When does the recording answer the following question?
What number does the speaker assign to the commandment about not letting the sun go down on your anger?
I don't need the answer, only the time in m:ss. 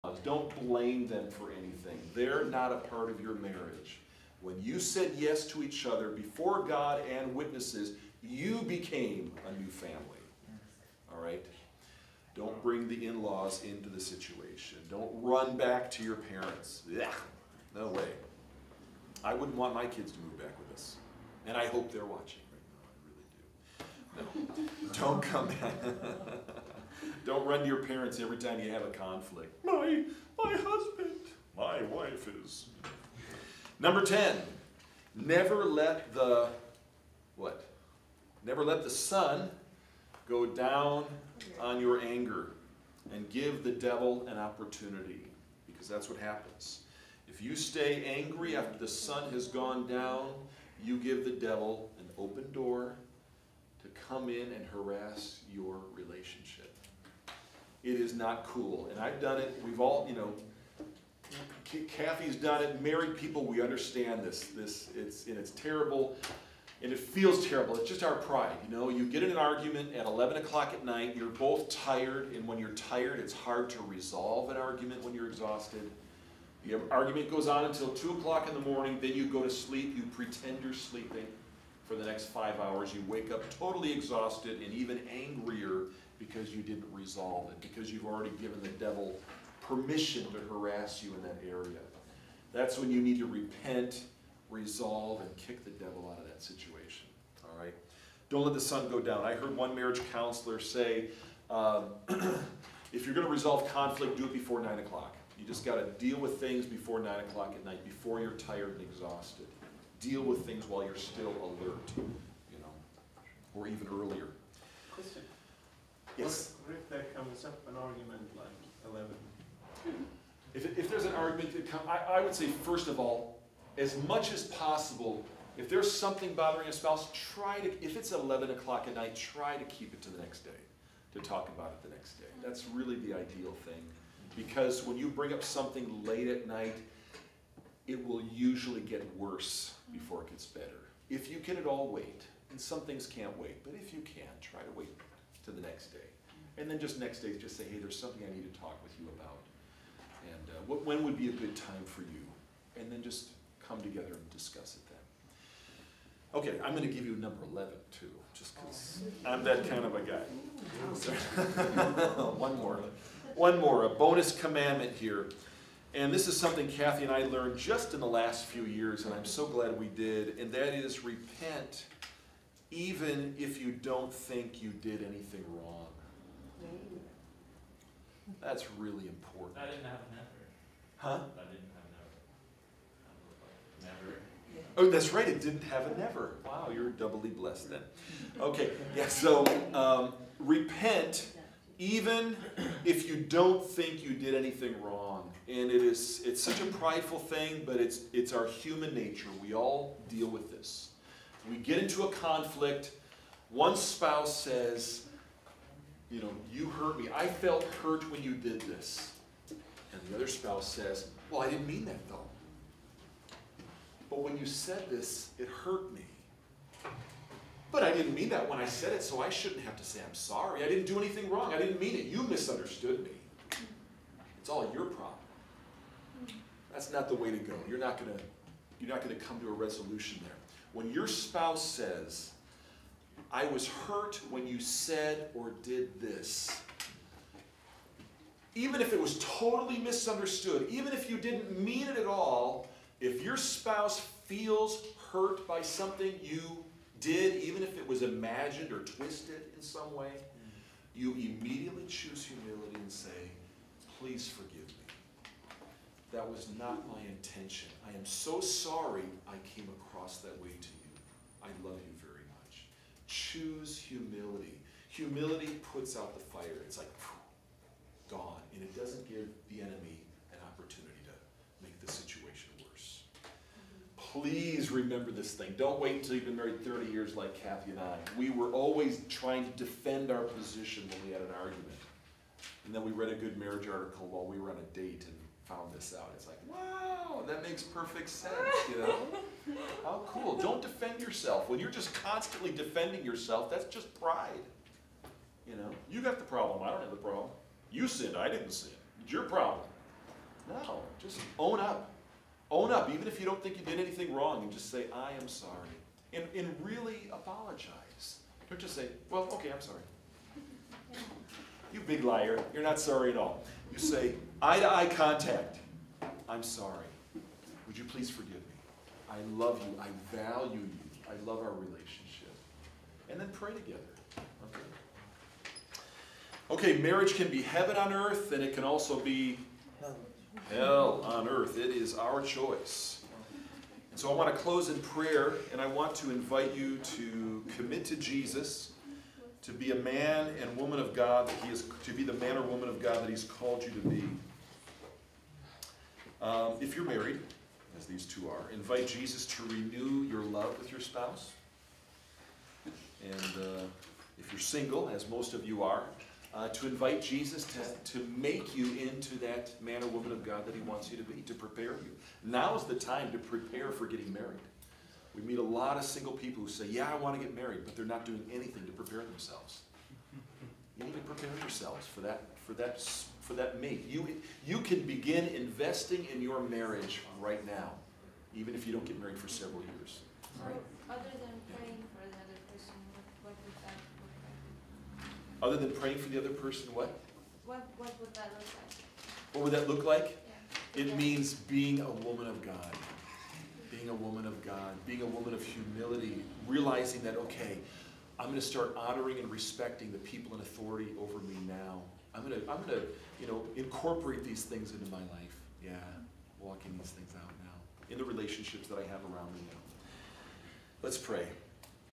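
0:33.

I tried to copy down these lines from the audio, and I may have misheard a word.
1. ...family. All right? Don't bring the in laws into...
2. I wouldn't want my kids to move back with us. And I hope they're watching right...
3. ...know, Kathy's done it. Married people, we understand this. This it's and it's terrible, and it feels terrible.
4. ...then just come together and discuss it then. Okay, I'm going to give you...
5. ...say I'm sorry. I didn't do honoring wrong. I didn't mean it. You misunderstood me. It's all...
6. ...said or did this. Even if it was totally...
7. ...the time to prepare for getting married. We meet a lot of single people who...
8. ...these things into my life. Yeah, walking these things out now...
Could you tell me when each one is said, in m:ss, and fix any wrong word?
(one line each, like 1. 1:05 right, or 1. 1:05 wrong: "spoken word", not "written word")
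1. 0:09 right
2. 0:19 right
3. 1:00 right
4. 2:32 right
5. 3:39 wrong: "anything", not "honoring"
6. 3:54 right
7. 6:02 right
8. 6:44 right.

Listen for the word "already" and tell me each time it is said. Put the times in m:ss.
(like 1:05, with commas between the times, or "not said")
1:28.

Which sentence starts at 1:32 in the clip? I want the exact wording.
That's when you need to repent, resolve, and kick the devil out of that situation.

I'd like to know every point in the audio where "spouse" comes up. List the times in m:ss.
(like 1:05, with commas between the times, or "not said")
2:06, 3:23, 3:30, 3:51, 4:03, 5:50.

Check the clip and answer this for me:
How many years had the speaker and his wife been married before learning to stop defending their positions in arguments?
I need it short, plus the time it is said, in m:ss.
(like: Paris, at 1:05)
30 years, at 4:36.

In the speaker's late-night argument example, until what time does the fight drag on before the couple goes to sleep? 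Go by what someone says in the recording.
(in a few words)
2 o'clock.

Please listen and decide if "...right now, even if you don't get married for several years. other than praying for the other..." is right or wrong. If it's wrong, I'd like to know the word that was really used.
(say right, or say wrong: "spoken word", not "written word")
right.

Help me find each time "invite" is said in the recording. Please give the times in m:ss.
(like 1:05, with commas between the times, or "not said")
5:36, 5:48, 5:56.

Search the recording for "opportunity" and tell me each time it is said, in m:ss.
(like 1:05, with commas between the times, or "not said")
0:44, 4:30.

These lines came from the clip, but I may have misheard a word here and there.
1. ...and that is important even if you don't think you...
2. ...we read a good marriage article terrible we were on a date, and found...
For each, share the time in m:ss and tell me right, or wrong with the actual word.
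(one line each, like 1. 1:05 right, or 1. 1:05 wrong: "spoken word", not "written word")
1. 2:50 wrong: "repent", not "important"
2. 4:42 wrong: "while", not "terrible".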